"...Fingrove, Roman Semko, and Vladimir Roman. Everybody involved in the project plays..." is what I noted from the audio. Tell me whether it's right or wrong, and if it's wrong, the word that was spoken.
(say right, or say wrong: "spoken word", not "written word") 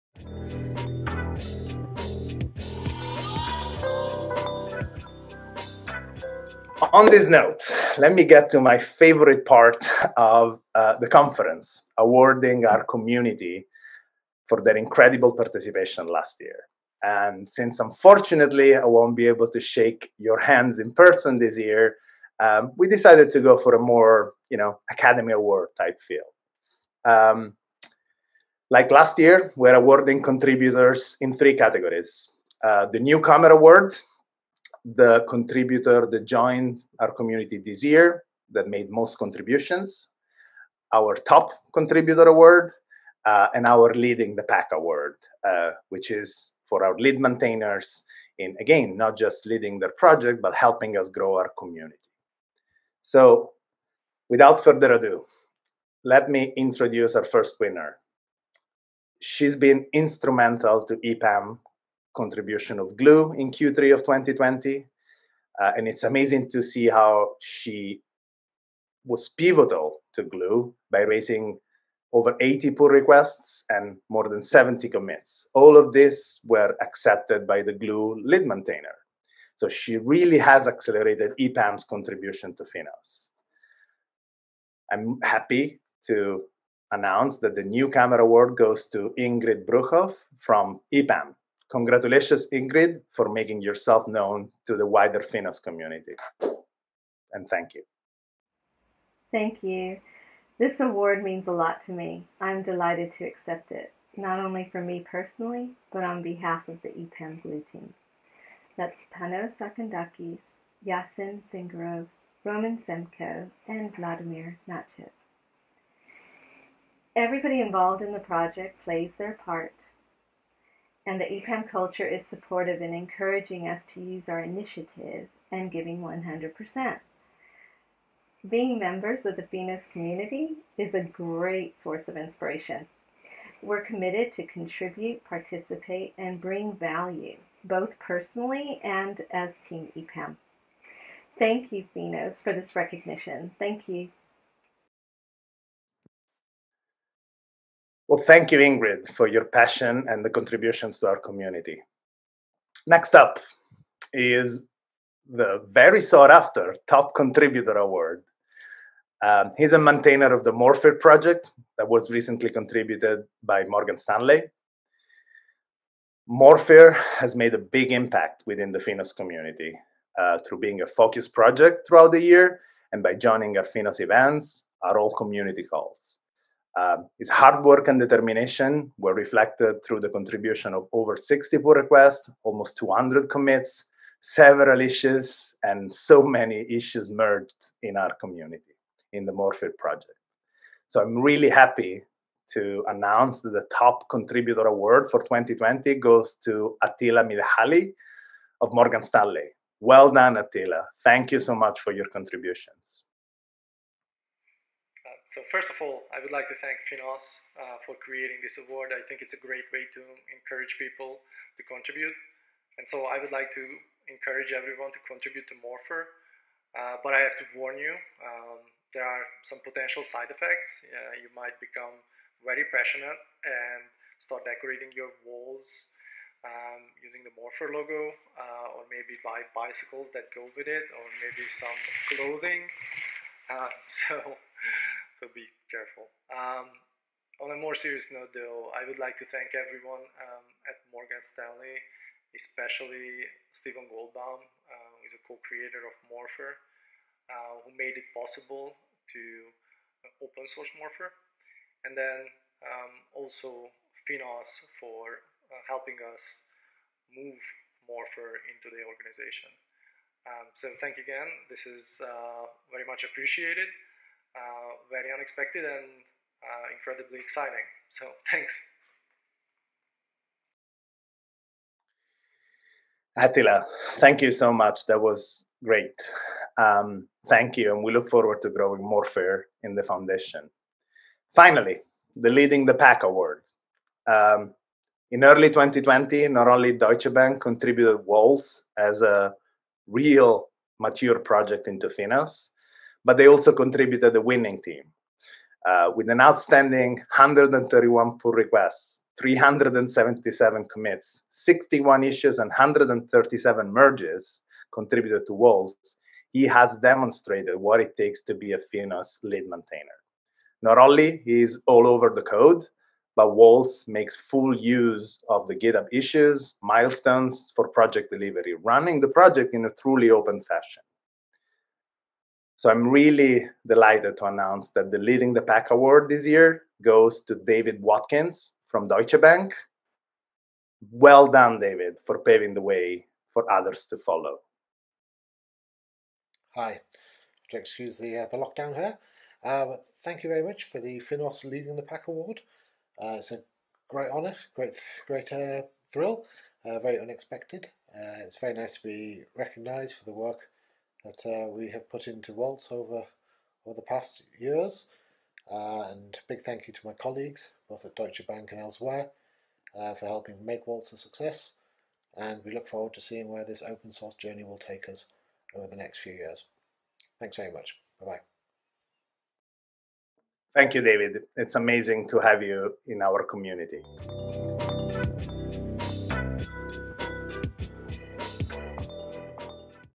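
wrong: "Nachit", not "Roman".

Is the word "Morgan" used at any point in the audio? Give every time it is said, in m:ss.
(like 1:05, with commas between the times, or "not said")
2:43, 3:18, 4:00.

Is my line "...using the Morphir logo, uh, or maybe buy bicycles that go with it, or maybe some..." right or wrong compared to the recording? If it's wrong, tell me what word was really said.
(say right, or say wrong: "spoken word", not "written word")
right.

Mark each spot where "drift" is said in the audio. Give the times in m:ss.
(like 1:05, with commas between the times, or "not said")
not said.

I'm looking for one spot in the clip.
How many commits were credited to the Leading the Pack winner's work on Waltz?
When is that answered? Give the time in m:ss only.
4:59.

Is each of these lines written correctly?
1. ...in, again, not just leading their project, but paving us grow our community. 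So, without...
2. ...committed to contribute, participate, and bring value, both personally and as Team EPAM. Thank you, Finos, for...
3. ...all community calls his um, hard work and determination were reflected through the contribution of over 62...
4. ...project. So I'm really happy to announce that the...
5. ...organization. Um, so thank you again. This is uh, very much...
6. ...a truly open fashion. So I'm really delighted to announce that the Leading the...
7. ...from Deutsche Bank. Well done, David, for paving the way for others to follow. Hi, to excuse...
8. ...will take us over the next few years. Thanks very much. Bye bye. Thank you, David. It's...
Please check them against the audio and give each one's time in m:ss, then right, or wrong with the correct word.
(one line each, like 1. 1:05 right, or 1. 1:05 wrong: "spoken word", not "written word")
1. 0:48 wrong: "helping", not "paving"
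2. 2:13 right
3. 2:54 wrong: "60", not "62"
4. 3:09 right
5. 4:18 right
6. 5:19 right
7. 5:28 right
8. 6:04 right.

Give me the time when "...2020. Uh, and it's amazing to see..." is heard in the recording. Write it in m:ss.
1:04.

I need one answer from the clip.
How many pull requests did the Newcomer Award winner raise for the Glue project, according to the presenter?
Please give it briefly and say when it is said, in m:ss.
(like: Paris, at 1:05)
over 80, at 1:12.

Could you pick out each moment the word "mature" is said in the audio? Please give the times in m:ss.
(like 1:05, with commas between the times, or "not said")
4:50.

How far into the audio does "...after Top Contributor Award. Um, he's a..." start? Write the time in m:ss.
2:36.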